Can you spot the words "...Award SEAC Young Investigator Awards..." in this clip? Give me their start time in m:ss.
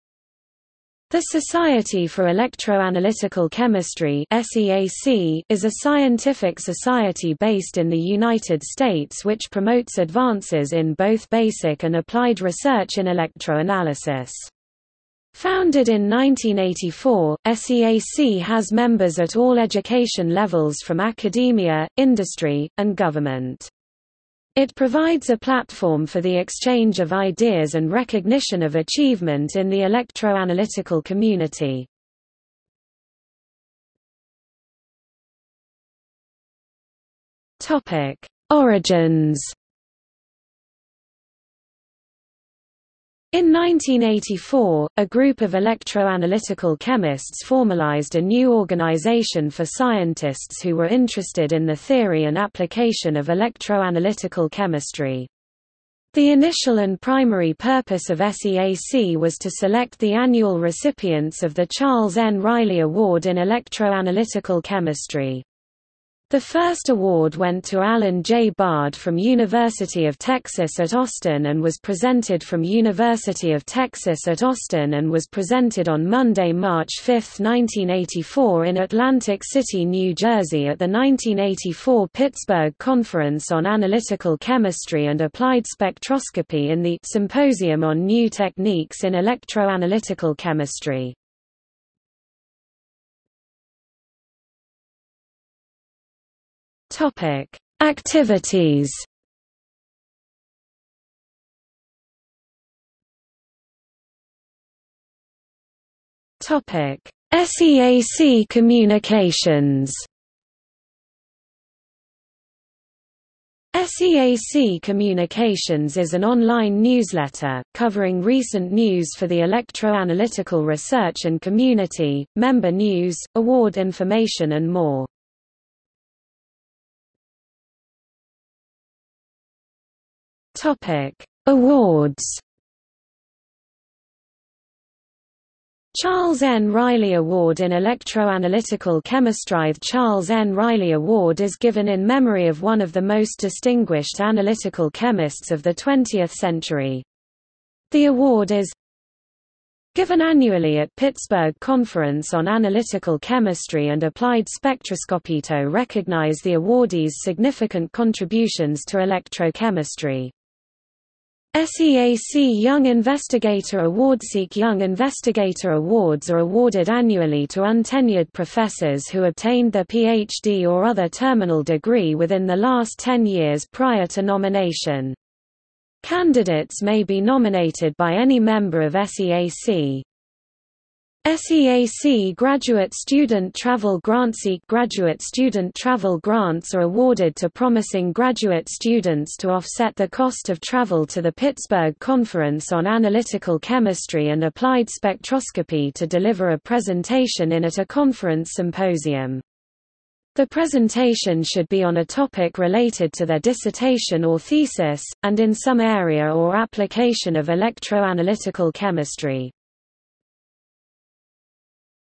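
2:43.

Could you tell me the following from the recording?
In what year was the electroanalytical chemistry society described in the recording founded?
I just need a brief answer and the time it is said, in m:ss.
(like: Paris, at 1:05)
1984, at 0:15.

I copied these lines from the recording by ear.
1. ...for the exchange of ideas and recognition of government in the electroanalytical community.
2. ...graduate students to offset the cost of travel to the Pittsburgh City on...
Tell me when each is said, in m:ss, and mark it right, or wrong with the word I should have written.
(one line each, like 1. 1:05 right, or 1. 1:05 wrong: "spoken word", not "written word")
1. 0:26 wrong: "achievement", not "government"
2. 3:08 wrong: "Conference", not "City".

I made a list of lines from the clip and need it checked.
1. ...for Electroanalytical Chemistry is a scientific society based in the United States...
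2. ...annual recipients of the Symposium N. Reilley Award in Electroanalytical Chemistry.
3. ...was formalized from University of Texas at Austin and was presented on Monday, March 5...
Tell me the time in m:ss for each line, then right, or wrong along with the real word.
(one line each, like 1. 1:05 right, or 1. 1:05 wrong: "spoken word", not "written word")
1. 0:02 right
2. 1:00 wrong: "Charles", not "Symposium"
3. 1:11 wrong: "presented", not "formalized".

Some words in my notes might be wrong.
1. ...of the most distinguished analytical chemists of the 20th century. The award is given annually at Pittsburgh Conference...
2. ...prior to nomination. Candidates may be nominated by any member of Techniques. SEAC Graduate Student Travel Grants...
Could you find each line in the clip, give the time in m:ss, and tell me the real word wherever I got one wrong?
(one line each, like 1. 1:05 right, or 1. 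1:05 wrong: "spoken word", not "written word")
1. 2:22 right
2. 2:53 wrong: "SEAC", not "Techniques".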